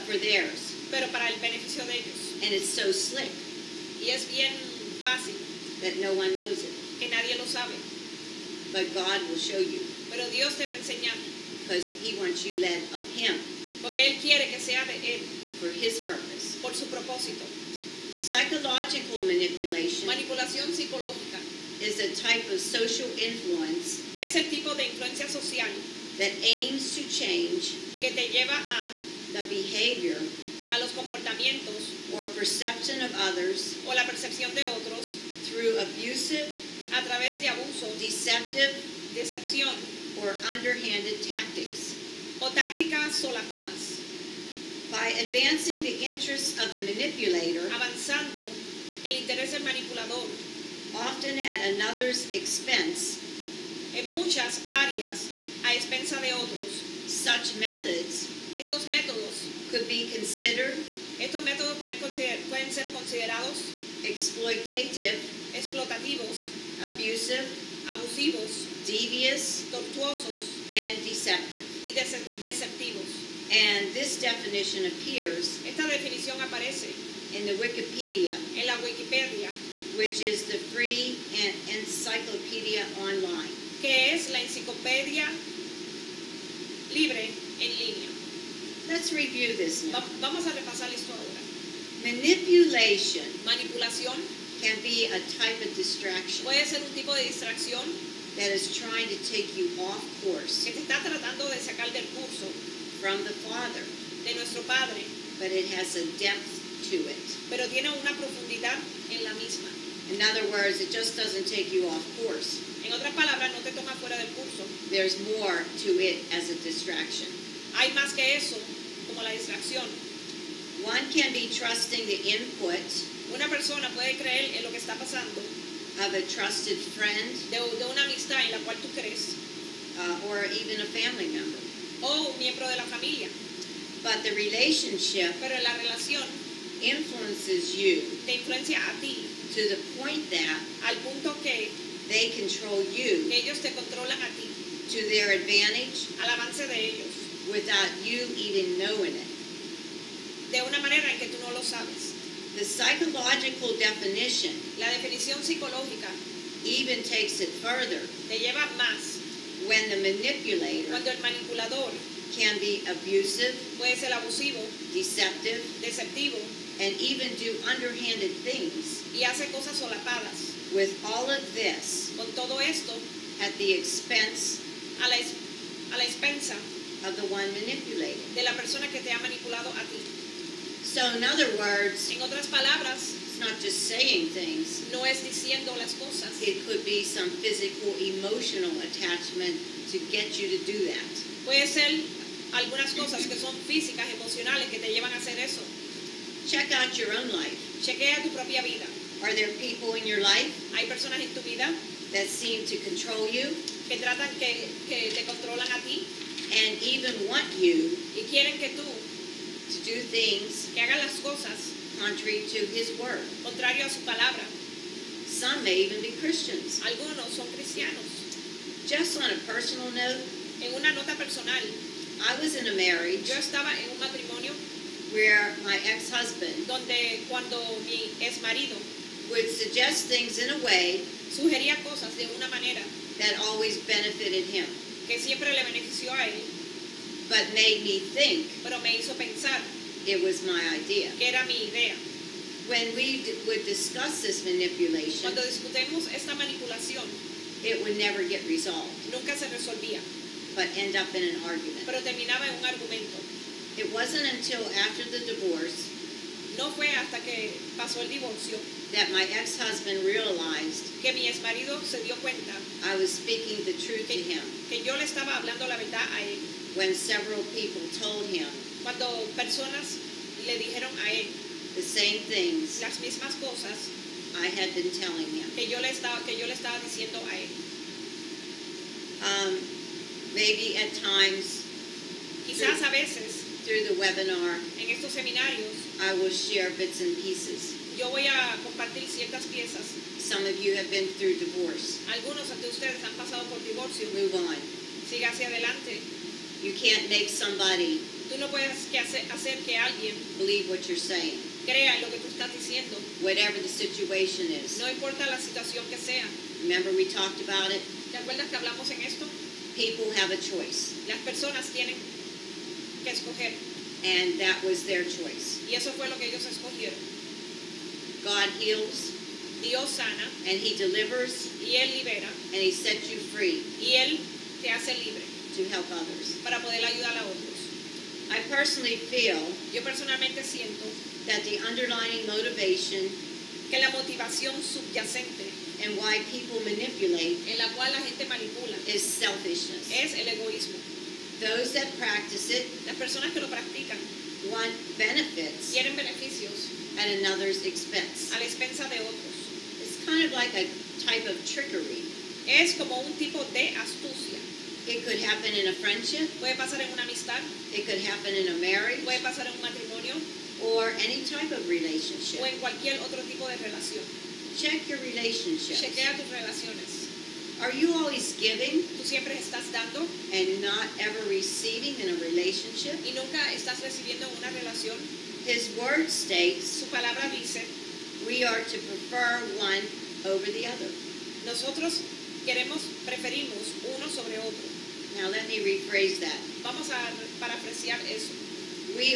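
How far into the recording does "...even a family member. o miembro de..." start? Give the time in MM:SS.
02:10.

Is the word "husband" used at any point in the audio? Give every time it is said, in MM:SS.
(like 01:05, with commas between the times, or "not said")
03:45, 04:19.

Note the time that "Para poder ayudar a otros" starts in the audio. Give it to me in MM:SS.
05:26.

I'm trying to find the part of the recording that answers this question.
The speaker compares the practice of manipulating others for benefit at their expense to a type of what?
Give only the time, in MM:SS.
05:50.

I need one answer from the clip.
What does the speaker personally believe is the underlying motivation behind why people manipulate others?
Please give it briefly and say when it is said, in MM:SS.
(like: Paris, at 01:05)
selfishness, at 05:38.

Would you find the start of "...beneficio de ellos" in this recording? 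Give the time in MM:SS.
00:01.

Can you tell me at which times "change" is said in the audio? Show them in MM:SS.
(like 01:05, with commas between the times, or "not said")
00:27.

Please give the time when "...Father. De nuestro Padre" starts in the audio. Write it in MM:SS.
01:43.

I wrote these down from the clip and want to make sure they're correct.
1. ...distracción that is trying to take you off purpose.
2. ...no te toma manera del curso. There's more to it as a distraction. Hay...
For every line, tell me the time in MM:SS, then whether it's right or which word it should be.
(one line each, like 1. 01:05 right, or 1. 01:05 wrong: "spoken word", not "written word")
1. 01:37 wrong: "course", not "purpose"
2. 01:53 wrong: "fuera", not "manera".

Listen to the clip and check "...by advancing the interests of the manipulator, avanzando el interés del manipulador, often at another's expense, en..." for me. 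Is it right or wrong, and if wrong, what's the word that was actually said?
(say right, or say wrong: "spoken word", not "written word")
right.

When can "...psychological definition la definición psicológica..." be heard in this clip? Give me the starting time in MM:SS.
02:32.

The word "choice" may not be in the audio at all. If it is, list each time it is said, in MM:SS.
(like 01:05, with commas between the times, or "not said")
05:10, 05:15.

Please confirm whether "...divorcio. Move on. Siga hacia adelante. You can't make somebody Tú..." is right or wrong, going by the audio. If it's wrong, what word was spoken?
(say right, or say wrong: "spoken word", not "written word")
right.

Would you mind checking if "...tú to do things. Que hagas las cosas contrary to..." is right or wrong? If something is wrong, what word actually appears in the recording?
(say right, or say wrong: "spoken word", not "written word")
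right.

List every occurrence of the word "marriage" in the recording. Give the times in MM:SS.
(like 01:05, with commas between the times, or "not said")
03:42, 05:58.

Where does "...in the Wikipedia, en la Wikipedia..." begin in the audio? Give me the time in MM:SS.
01:17.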